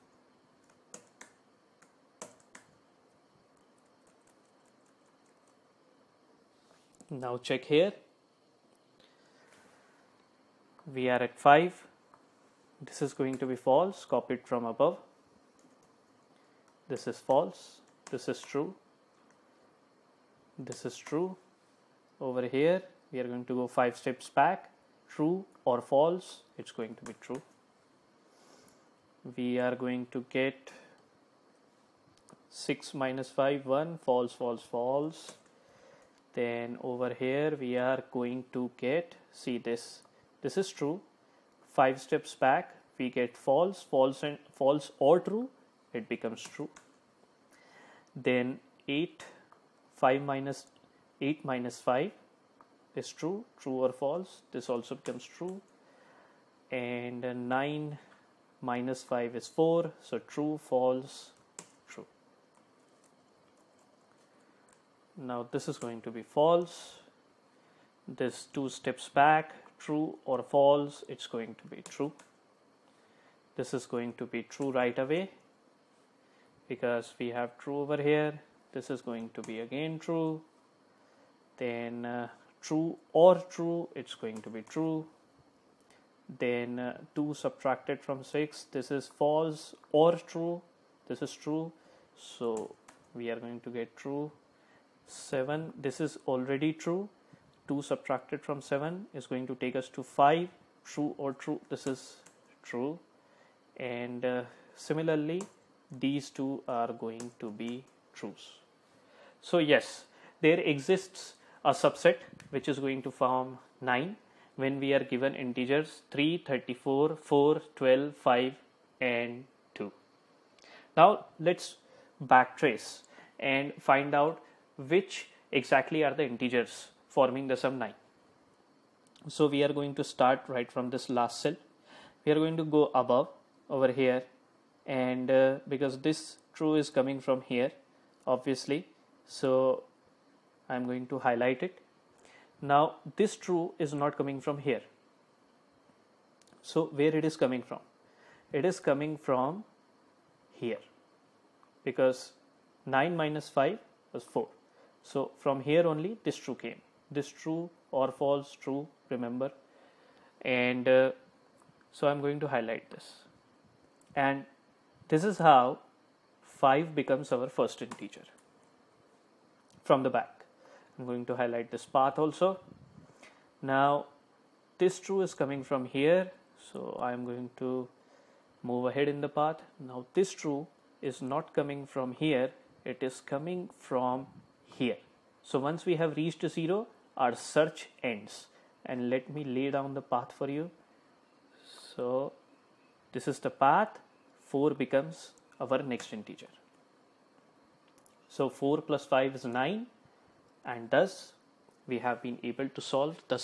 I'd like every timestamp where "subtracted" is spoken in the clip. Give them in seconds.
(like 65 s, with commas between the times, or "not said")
87 s, 97 s.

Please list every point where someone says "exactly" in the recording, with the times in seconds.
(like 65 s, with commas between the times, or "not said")
125 s.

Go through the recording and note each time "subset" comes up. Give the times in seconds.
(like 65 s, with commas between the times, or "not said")
111 s.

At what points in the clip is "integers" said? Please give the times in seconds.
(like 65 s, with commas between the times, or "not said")
115 s, 126 s, 167 s, 196 s.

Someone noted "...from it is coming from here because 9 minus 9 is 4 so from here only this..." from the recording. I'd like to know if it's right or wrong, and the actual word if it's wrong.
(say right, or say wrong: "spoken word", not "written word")
wrong: "5", not "9".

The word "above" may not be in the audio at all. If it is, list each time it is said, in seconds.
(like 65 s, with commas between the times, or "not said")
14 s, 133 s.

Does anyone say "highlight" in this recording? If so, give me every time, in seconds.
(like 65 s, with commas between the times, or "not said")
141 s, 162 s, 171 s.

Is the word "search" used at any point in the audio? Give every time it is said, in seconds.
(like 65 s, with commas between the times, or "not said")
187 s.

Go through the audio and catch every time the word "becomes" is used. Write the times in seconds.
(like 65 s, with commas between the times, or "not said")
46 s, 55 s, 166 s, 194 s.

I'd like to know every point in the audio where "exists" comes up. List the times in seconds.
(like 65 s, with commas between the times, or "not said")
110 s.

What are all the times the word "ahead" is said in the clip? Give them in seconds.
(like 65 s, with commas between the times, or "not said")
178 s.